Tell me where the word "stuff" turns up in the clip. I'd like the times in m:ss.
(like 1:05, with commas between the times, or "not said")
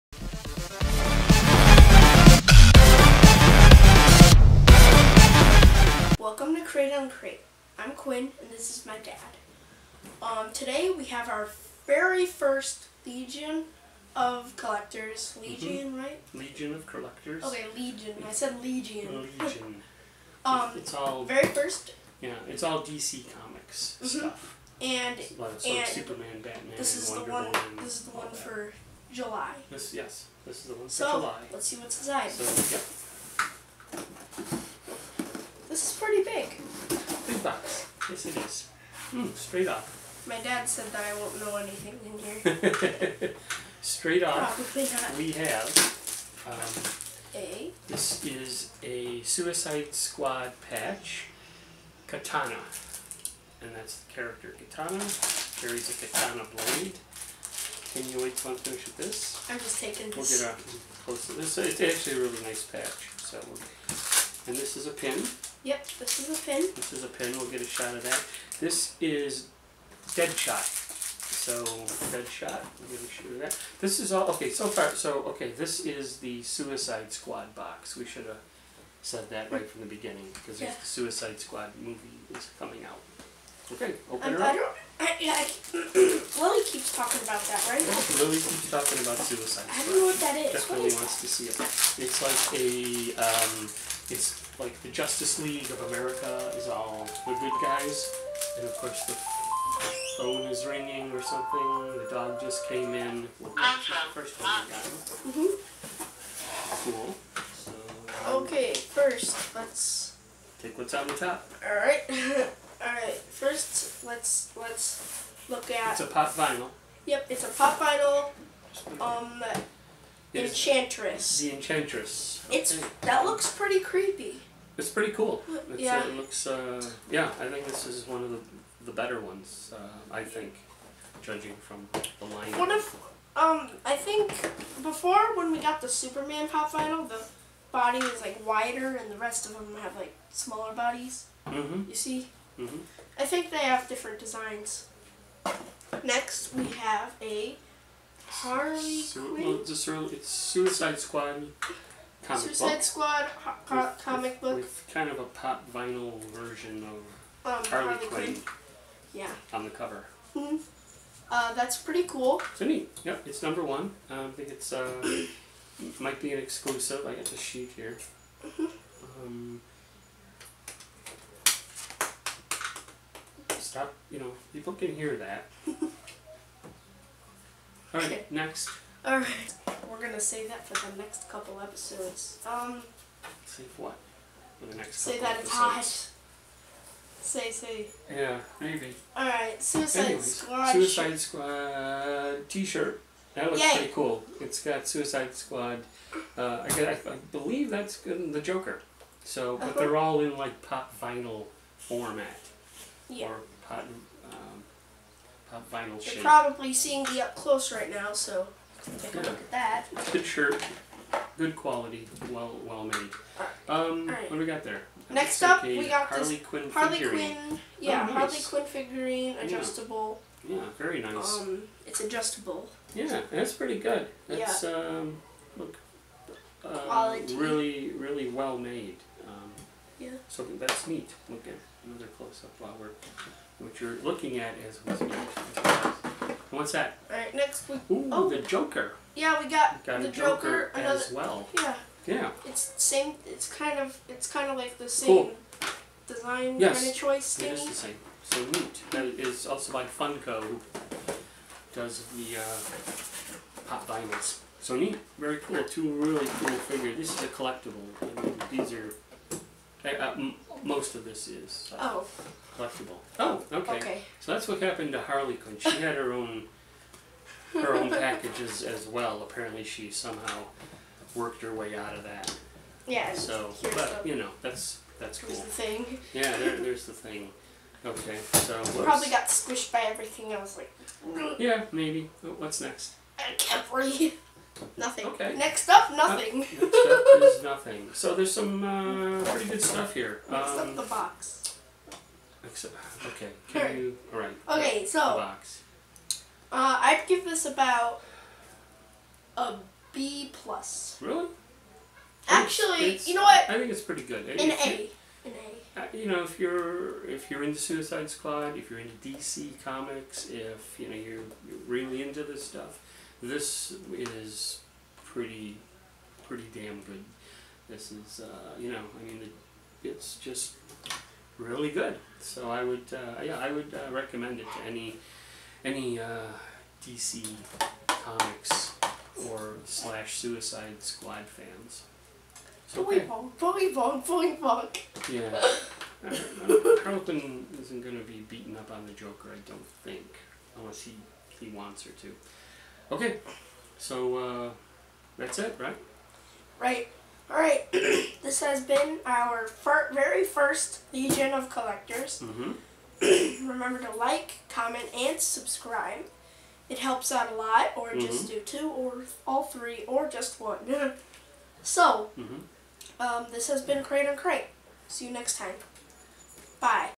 0:24, 4:49, 5:12.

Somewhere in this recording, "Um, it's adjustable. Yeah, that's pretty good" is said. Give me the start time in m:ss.
3:41.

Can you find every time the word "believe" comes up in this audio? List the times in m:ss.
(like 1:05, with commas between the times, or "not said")
3:17.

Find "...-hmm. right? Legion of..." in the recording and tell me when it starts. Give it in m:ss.
0:15.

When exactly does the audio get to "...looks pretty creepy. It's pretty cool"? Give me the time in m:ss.
2:03.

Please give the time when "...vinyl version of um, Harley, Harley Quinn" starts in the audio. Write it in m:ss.
2:35.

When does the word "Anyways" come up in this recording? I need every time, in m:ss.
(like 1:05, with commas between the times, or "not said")
3:10.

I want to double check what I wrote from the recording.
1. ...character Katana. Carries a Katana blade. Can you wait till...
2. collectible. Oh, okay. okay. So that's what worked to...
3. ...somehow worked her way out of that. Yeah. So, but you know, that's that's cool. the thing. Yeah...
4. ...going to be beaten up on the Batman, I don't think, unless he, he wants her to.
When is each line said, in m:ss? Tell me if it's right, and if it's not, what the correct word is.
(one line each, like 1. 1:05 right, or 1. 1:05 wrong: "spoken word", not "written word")
1. 0:54 right
2. 4:22 wrong: "happened", not "worked"
3. 4:29 right
4. 5:37 wrong: "Joker", not "Batman".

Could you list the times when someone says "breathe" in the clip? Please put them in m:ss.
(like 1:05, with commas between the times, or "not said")
4:43.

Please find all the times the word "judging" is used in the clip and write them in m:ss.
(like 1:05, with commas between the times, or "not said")
2:11.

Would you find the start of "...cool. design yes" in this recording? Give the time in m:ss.
4:05.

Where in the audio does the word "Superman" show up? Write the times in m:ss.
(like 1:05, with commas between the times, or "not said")
0:25, 2:15.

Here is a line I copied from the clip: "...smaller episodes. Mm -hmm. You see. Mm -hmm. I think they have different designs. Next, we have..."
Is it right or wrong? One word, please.
wrong.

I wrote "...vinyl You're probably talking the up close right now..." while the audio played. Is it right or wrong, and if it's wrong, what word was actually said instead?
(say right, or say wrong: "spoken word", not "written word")
wrong: "seeing", not "talking".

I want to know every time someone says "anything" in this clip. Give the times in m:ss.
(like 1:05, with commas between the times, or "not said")
0:41.